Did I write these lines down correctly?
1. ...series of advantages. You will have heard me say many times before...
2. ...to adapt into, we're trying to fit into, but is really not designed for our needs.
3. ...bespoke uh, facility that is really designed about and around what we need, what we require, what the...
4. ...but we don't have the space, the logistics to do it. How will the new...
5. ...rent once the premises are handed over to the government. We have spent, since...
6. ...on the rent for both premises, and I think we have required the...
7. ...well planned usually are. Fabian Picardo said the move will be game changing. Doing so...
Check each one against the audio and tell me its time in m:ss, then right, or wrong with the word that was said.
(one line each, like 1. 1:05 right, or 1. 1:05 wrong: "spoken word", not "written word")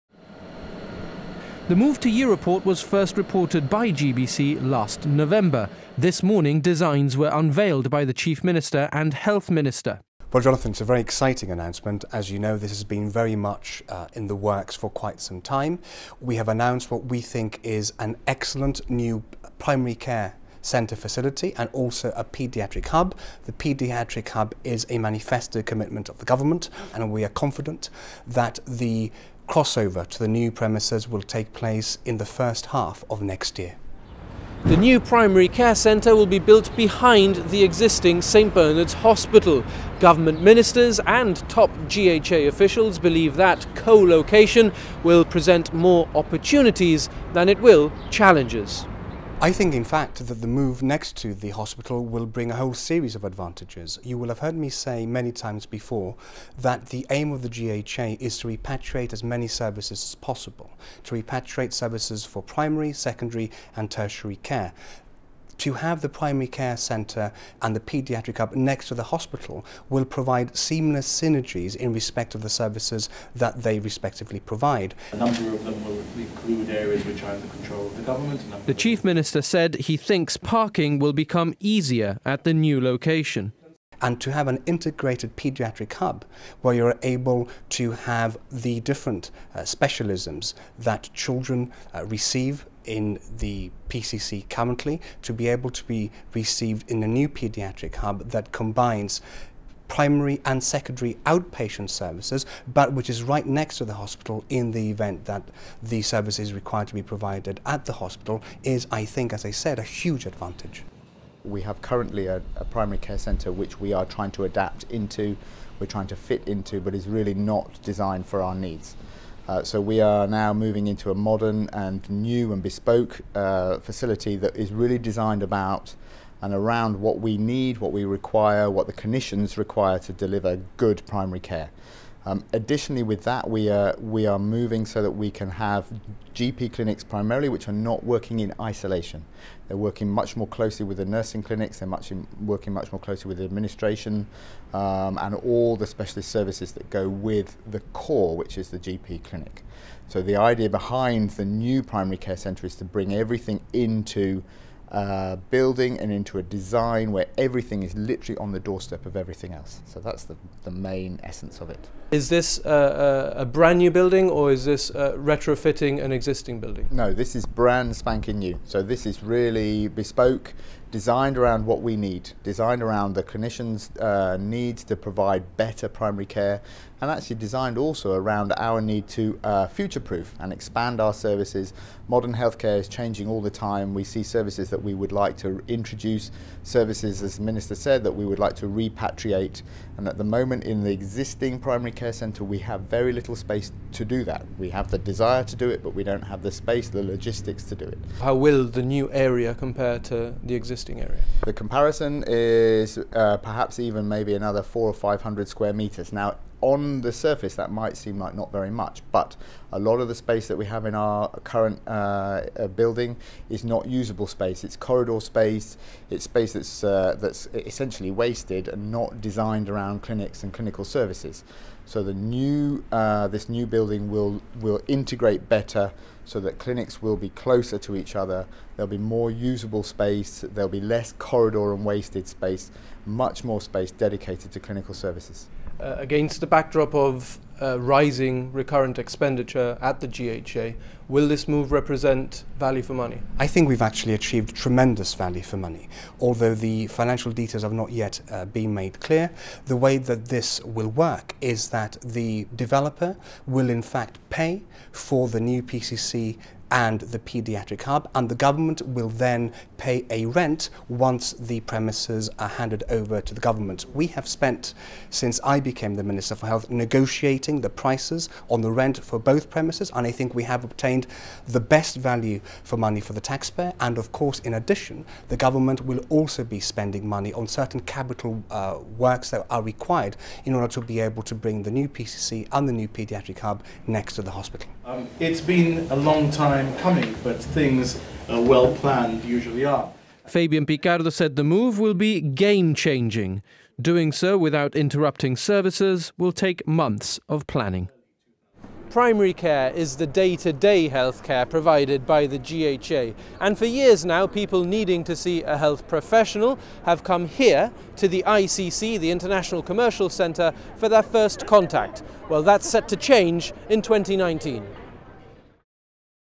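1. 0:52 right
2. 1:54 right
3. 2:02 right
4. 3:15 right
5. 4:20 right
6. 4:28 wrong: "obtained", not "required"
7. 4:48 right.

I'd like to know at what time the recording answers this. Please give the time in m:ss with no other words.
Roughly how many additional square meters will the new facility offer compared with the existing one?
3:24.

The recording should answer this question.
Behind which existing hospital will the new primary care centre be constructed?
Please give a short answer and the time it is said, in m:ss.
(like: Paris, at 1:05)
St Bernard's Hospital, at 0:38.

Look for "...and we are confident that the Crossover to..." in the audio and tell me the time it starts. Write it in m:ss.
0:26.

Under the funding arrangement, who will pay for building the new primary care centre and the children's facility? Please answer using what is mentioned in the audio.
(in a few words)
The developer.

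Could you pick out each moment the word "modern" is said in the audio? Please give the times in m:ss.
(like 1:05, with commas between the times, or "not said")
2:01, 3:02.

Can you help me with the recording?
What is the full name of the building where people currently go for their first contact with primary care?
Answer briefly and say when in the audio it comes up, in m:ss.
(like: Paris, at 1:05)
International Commercial Centre, at 5:09.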